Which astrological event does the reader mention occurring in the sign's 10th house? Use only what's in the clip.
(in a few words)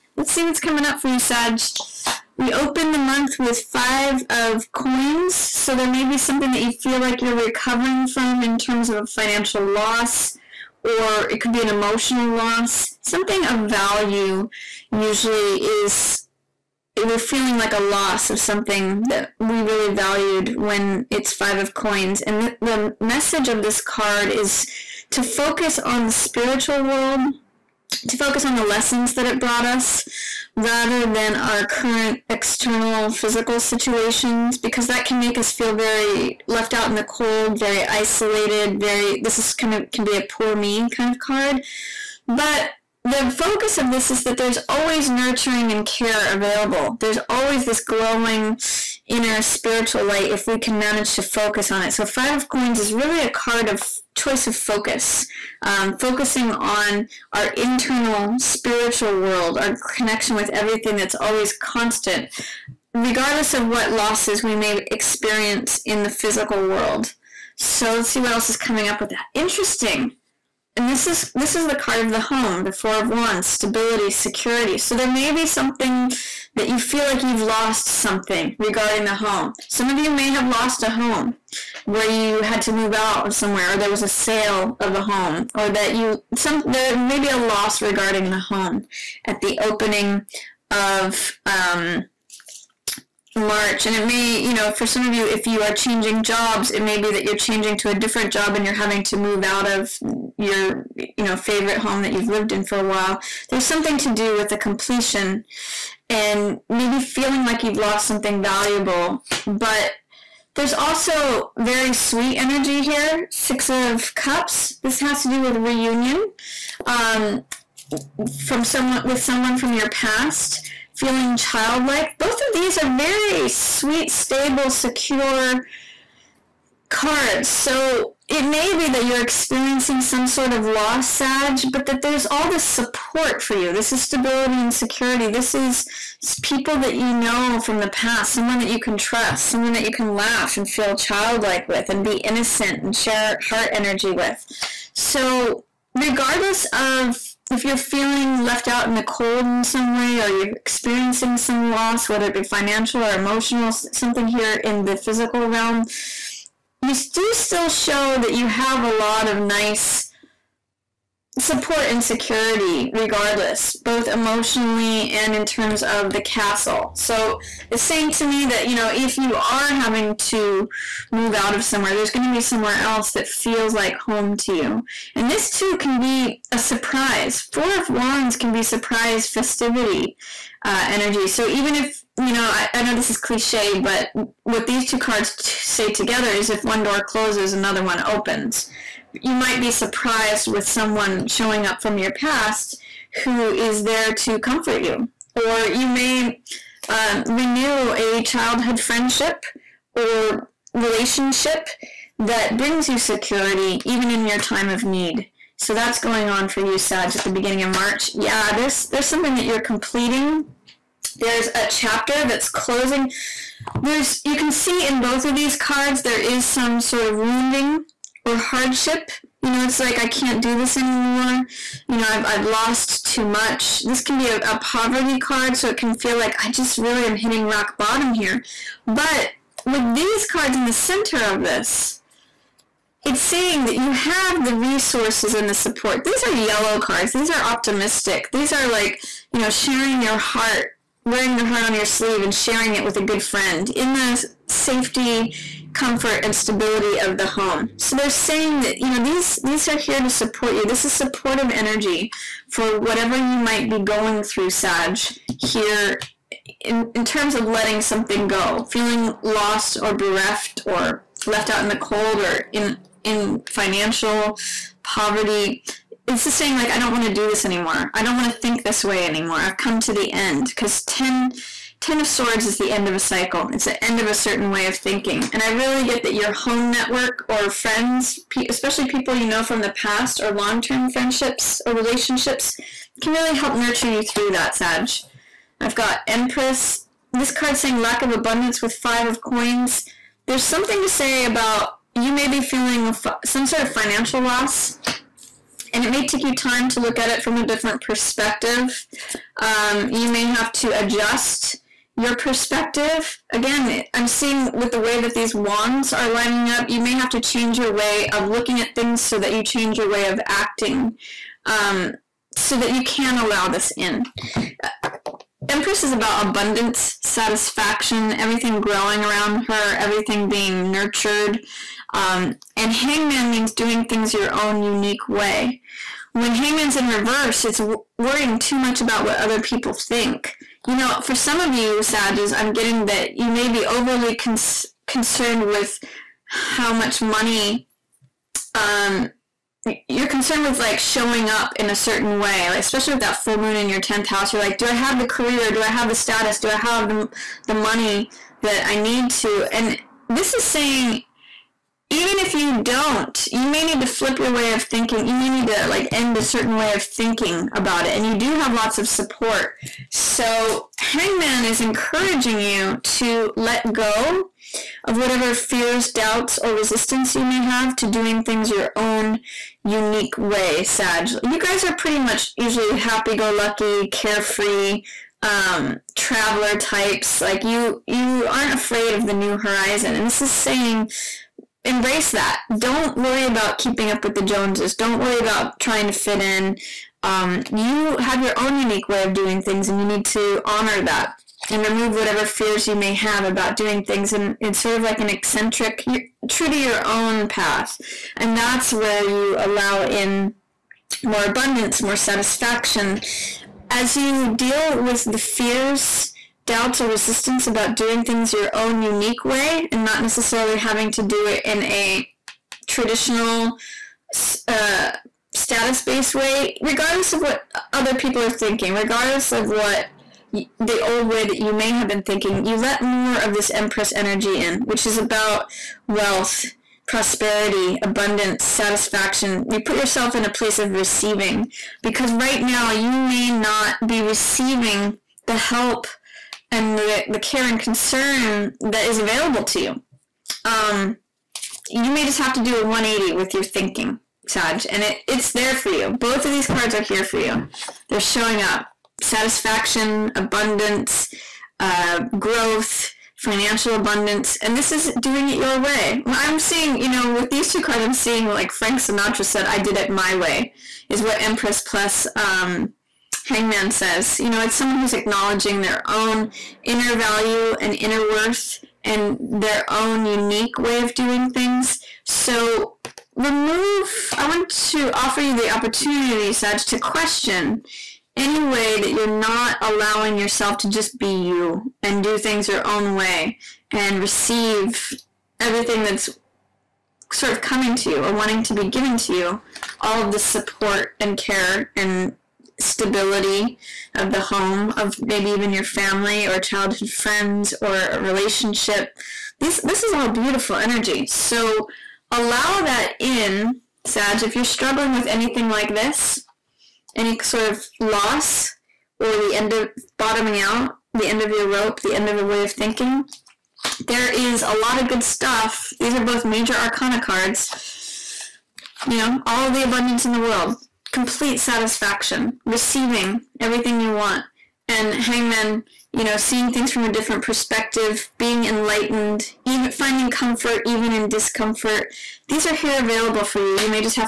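Full moon.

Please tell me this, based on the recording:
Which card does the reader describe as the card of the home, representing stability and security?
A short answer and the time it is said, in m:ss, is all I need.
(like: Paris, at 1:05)
4 of Wands, at 1:12.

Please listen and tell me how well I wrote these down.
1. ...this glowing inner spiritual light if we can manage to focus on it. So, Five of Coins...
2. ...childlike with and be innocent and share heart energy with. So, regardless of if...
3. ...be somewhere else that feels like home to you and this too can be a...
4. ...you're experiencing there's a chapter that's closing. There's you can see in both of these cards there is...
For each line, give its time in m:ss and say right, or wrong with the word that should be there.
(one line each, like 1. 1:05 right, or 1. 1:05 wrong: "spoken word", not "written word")
1. 0:47 right
2. 2:20 right
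3. 2:52 right
4. 3:29 wrong: "completing", not "experiencing".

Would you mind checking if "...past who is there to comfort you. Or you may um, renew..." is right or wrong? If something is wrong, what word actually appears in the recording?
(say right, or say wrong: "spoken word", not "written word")
right.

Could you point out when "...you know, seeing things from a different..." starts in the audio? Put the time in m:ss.
8:45.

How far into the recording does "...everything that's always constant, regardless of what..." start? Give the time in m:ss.
1:00.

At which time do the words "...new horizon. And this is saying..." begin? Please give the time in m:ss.
6:19.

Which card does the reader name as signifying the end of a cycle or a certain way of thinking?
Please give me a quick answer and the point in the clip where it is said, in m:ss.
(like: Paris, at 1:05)
10 of Swords, at 4:31.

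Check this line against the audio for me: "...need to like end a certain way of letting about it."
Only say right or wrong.
wrong.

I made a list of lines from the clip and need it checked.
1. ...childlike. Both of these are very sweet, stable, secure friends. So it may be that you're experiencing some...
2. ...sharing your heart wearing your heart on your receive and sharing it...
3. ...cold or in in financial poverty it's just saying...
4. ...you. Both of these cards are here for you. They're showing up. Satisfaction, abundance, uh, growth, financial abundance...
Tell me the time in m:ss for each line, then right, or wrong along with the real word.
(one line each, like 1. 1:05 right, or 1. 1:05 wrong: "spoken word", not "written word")
1. 2:01 wrong: "cards", not "friends"
2. 3:59 wrong: "sleeve", not "receive"
3. 4:21 right
4. 7:25 right.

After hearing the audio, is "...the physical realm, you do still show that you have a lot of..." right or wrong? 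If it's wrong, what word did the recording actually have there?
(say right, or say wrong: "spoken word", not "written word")
right.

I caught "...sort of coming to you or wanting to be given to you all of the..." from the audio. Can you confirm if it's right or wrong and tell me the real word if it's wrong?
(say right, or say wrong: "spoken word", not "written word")
right.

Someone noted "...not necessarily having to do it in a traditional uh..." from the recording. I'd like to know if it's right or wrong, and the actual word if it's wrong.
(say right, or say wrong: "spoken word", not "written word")
right.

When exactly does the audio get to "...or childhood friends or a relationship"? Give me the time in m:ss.
8:16.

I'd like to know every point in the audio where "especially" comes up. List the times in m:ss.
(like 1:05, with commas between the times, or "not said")
4:38, 5:42.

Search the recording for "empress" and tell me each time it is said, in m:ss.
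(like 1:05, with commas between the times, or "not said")
4:46, 5:15, 7:03, 7:41.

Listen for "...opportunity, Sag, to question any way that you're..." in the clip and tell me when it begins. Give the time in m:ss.
7:55.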